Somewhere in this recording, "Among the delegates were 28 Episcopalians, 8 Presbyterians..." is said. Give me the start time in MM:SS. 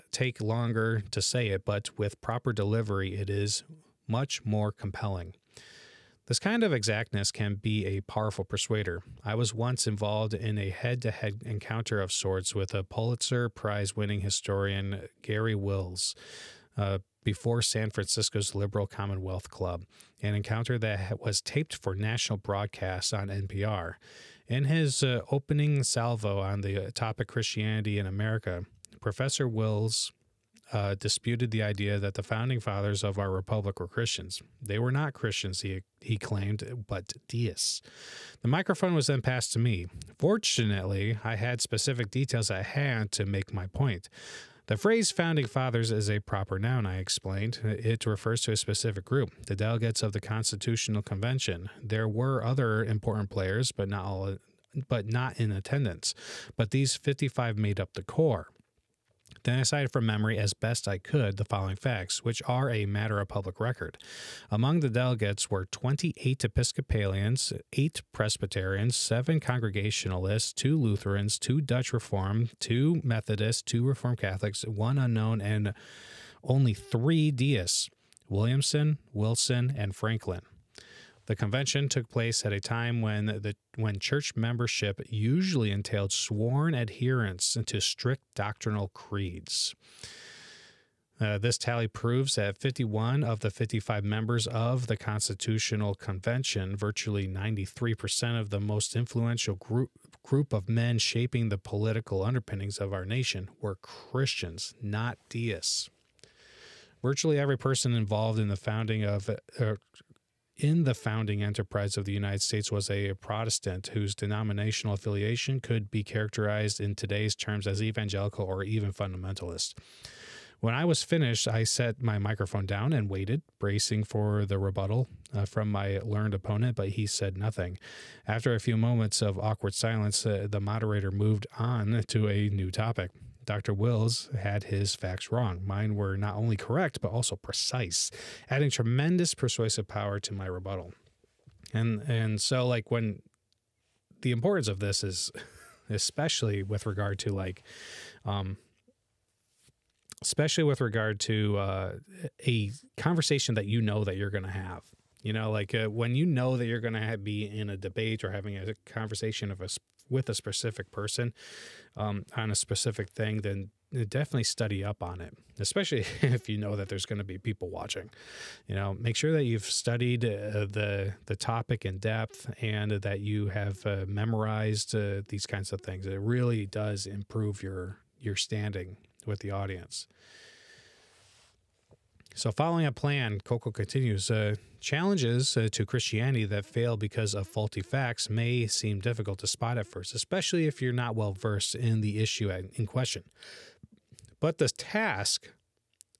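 01:04.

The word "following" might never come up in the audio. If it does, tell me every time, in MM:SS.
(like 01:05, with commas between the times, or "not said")
01:01, 03:02.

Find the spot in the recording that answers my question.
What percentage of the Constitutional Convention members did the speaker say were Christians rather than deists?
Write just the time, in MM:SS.
01:37.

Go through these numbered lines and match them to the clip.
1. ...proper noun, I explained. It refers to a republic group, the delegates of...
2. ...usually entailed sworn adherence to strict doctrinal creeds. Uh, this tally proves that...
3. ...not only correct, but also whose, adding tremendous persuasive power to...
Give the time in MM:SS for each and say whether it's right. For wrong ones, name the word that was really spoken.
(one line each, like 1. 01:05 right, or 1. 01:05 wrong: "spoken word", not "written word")
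1. 00:46 wrong: "specific", not "republic"
2. 01:25 right
3. 02:16 wrong: "precise", not "whose".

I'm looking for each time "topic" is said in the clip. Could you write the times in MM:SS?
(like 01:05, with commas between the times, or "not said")
00:26, 02:12, 02:51.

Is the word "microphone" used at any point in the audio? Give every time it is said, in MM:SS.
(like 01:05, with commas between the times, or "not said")
00:38, 02:02.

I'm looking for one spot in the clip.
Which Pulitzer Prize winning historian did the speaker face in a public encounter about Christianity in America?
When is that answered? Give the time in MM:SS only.
00:15.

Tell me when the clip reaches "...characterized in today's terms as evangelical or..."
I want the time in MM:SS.
01:56.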